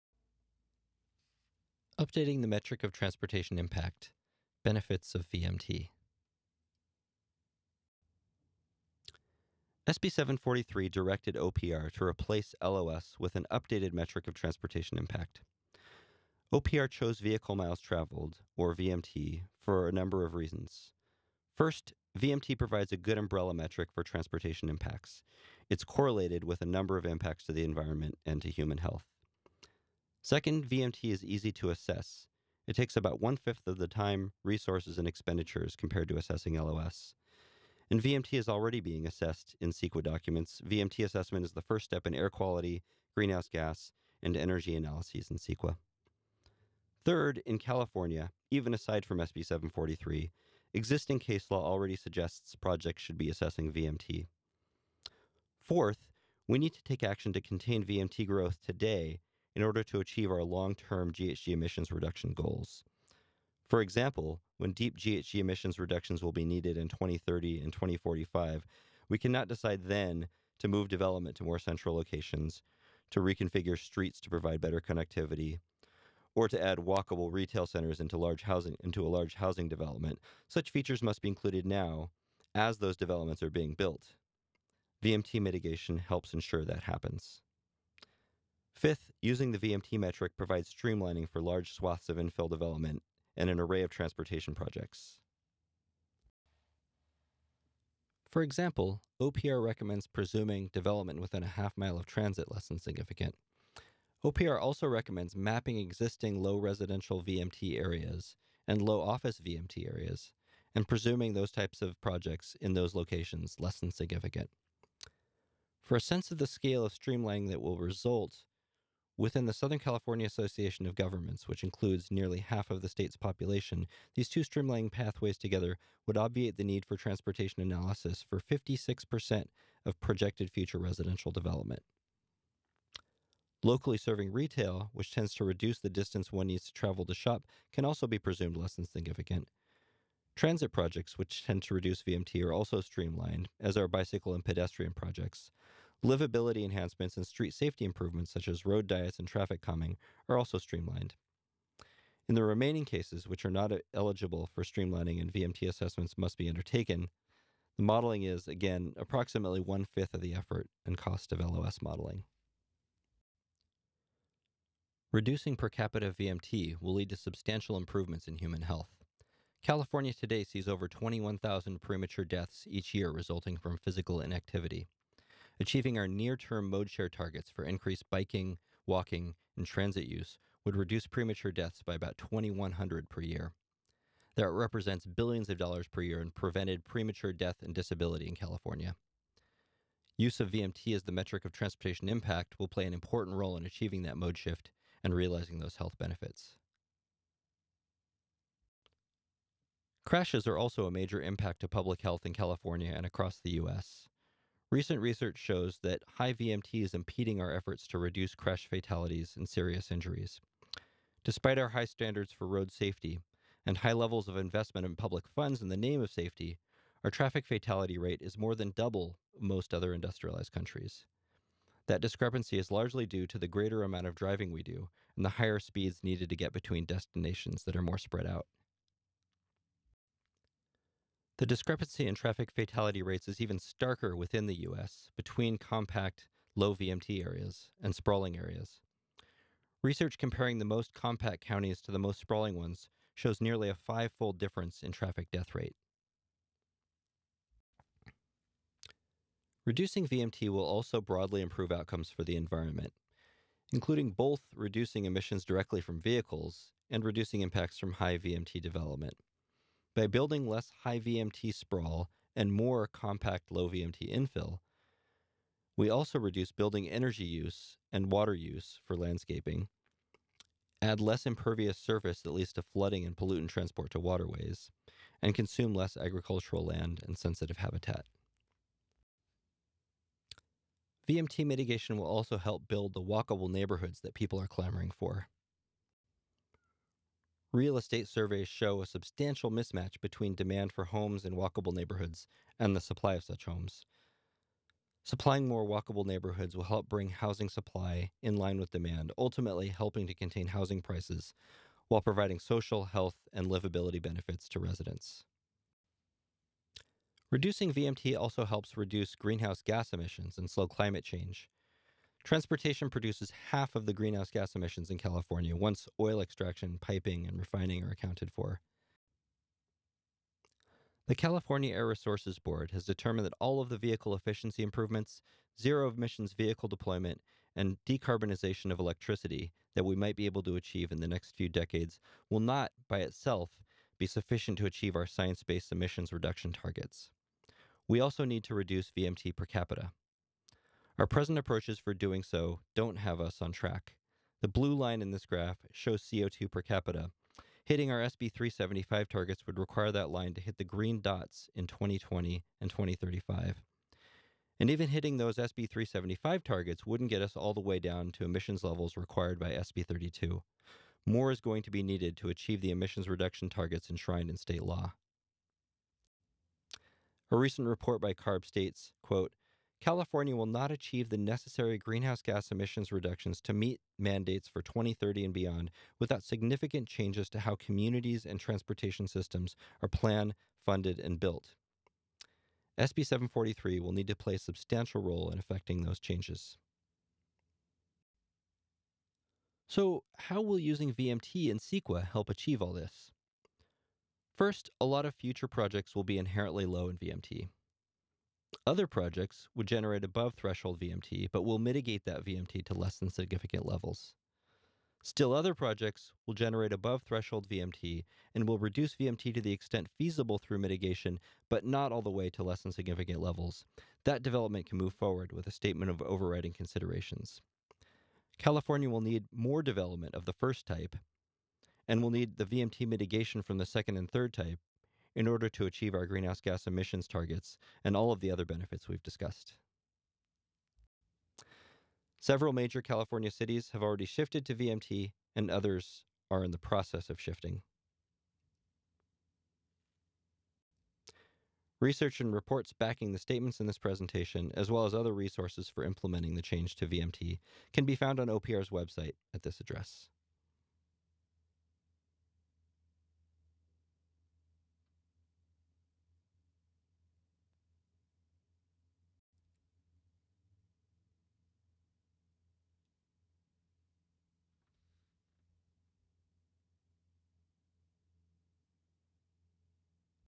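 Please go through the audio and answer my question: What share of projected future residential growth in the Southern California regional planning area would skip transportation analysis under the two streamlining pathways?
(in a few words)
56%.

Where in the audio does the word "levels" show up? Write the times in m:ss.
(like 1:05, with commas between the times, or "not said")
3:33, 5:58, 6:43, 6:53.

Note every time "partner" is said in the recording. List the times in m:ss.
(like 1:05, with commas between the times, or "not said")
not said.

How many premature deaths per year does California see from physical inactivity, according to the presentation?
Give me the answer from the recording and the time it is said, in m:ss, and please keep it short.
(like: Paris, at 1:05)
21,000, at 2:50.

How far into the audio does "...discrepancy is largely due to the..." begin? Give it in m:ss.
3:41.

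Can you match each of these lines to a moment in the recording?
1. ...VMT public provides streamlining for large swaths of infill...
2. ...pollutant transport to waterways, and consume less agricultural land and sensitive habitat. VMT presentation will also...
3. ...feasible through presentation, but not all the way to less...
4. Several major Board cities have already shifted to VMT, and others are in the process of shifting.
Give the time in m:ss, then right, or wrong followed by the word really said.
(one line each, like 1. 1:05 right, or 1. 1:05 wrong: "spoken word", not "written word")
1. 1:29 wrong: "metric", not "public"
2. 4:33 wrong: "mitigation", not "presentation"
3. 6:49 wrong: "mitigation", not "presentation"
4. 7:12 wrong: "California", not "Board".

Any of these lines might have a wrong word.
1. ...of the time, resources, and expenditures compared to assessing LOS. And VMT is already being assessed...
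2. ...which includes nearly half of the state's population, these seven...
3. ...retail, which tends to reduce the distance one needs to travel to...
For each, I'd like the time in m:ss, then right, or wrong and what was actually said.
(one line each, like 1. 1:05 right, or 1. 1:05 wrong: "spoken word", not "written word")
1. 0:33 right
2. 2:01 wrong: "two", not "seven"
3. 2:14 right.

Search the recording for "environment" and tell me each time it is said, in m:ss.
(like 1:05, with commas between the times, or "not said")
0:27, 4:12.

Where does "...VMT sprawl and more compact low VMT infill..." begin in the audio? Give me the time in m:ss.
4:21.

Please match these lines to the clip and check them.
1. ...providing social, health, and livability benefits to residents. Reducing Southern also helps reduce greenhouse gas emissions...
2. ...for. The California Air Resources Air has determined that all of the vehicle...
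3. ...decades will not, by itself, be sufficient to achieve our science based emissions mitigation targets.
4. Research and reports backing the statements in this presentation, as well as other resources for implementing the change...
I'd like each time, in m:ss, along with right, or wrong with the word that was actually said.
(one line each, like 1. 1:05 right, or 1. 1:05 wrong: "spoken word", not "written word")
1. 5:02 wrong: "VMT", not "Southern"
2. 5:18 wrong: "Board", not "Air"
3. 5:31 wrong: "reduction", not "mitigation"
4. 7:21 right.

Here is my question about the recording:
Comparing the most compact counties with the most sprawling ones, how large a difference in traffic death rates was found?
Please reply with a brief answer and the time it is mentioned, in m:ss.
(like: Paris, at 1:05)
five fold, at 4:03.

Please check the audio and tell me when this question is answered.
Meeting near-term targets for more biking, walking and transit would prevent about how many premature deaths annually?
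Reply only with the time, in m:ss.
3:02.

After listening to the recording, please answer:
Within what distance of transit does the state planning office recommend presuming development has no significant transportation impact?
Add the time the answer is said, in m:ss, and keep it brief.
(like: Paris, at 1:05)
half mile, at 1:41.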